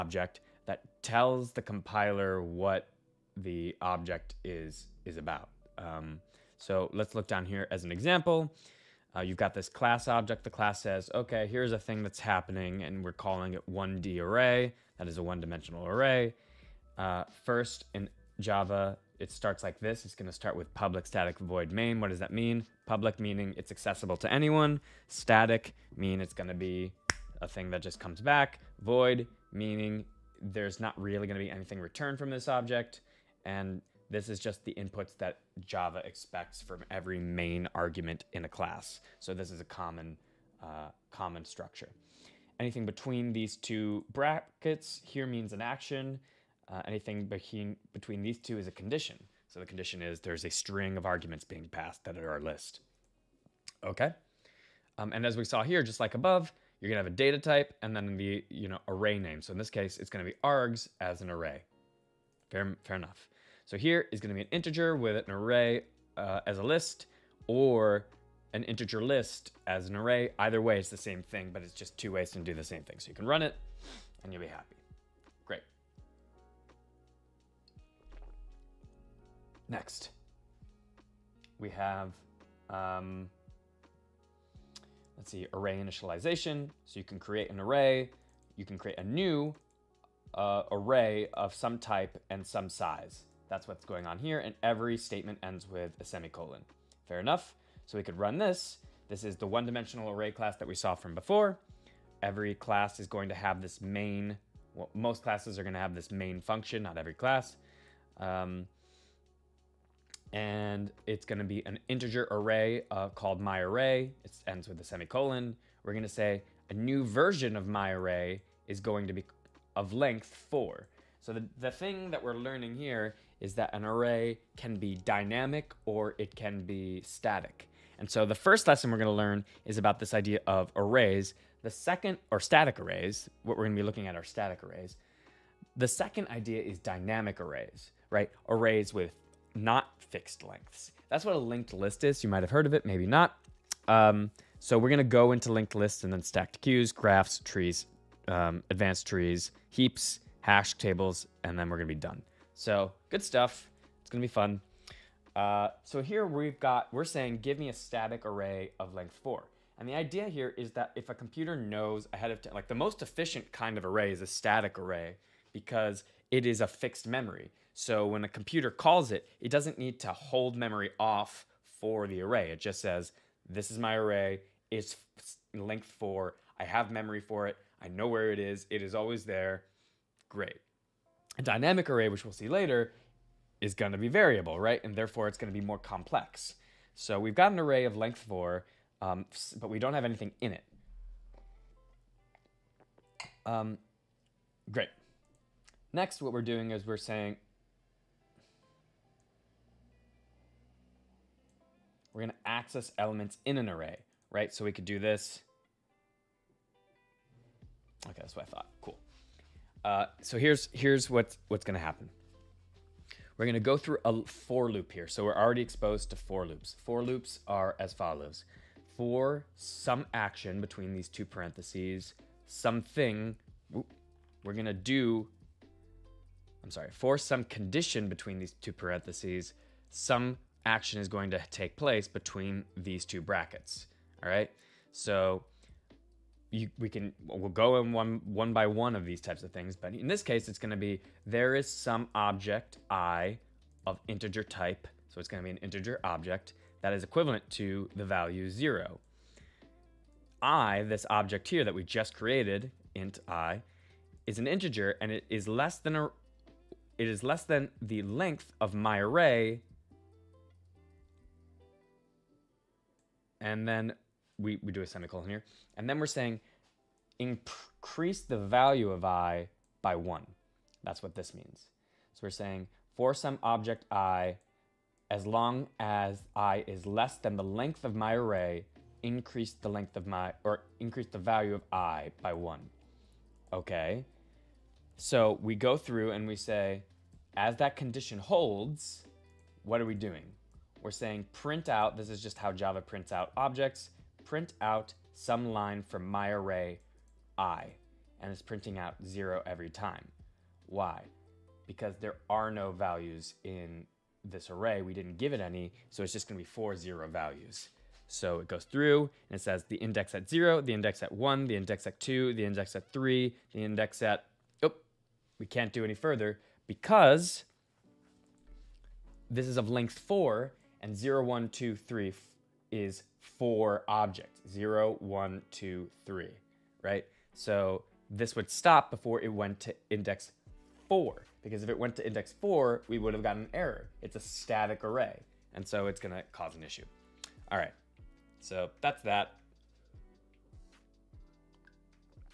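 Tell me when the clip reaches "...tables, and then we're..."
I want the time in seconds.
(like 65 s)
150 s.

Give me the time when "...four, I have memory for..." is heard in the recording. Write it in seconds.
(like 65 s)
175 s.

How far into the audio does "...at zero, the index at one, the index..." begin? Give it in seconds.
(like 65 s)
310 s.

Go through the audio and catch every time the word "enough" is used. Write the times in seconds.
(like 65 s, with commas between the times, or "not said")
62 s, 97 s.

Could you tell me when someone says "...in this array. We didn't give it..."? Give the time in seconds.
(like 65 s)
303 s.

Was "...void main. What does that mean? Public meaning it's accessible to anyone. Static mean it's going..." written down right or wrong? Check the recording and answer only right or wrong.
right.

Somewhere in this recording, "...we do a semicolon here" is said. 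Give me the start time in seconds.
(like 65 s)
264 s.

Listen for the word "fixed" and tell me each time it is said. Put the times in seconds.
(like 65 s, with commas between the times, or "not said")
139 s, 166 s.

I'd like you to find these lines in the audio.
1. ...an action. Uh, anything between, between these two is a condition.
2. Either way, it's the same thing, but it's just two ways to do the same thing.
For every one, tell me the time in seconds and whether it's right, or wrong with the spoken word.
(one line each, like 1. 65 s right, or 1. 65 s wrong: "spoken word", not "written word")
1. 45 s right
2. 70 s right.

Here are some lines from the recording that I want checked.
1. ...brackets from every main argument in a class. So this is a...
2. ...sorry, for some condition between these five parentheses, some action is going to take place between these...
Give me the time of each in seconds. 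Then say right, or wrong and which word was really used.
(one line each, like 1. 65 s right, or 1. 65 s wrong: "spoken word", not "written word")
1. 36 s wrong: "expects", not "brackets"
2. 226 s wrong: "two", not "five".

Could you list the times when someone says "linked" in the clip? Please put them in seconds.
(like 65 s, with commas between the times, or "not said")
141 s, 145 s.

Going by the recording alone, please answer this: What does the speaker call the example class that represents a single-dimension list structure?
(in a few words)
1D array.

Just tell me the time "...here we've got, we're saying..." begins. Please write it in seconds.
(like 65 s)
156 s.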